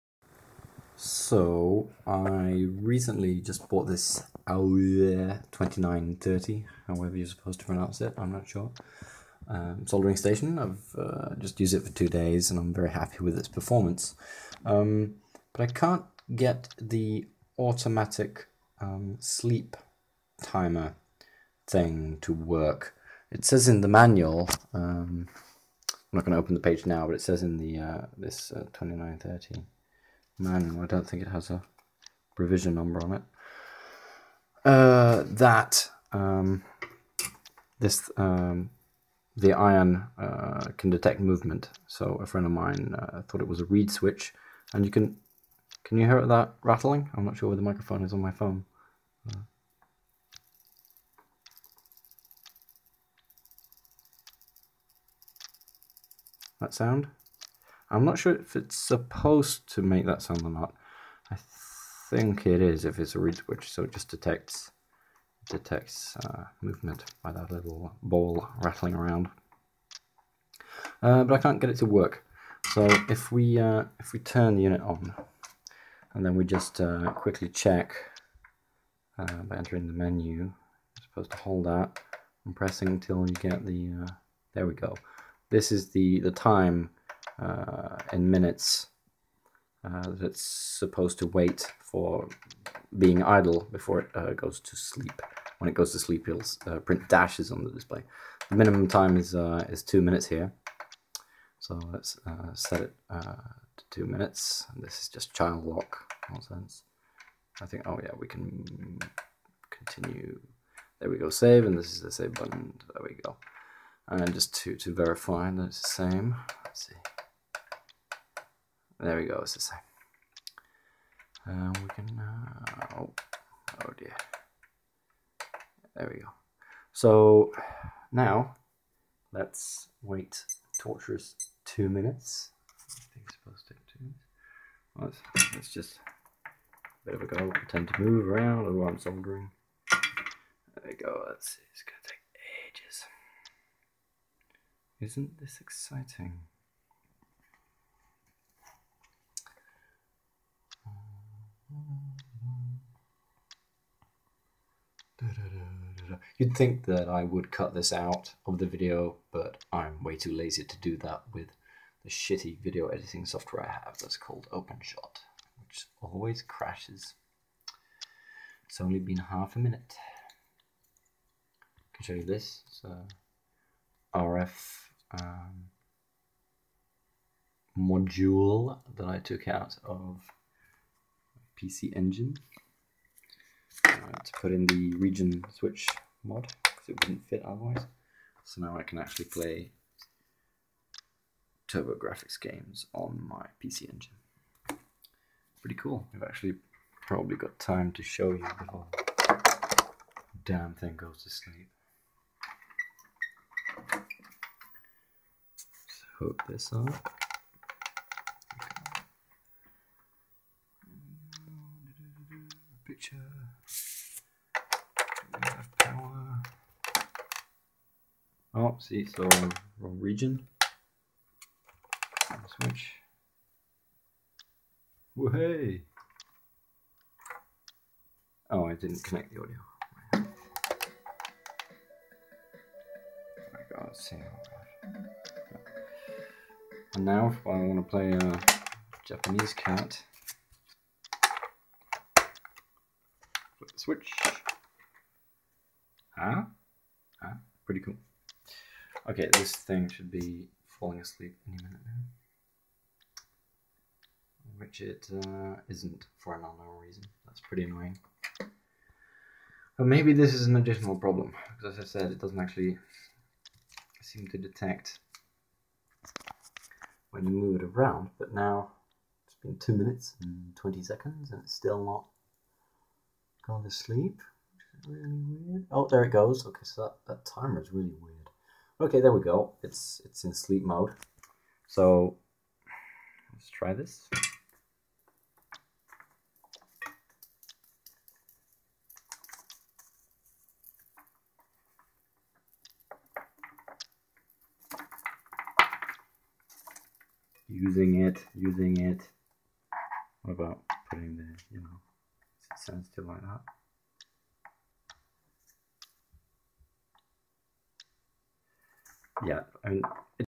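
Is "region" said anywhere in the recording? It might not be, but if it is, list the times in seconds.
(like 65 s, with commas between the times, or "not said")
184 s, 219 s.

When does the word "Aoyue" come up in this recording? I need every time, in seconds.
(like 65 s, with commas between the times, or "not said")
4 s.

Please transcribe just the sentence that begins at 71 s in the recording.
Uh, but I can't get it to work.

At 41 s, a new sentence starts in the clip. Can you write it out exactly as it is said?
So a friend of mine uh, thought it was a reed switch, and you can can you hear that rattling?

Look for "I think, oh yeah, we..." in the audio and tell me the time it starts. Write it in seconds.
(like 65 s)
107 s.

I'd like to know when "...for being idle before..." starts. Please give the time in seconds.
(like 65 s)
91 s.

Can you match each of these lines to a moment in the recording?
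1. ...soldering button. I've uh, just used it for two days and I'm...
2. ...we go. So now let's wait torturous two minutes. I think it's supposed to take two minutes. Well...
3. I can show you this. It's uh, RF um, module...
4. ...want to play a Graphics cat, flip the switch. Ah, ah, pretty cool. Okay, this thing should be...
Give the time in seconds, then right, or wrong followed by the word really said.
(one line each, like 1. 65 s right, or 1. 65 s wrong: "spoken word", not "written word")
1. 9 s wrong: "station", not "button"
2. 126 s right
3. 171 s right
4. 237 s wrong: "Japanese", not "Graphics".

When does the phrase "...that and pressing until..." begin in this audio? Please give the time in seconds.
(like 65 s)
81 s.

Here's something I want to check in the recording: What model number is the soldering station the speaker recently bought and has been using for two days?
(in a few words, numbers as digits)
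2930.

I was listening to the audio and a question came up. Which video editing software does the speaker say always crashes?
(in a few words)
OpenShot.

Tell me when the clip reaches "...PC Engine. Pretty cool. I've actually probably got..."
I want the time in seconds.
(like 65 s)
193 s.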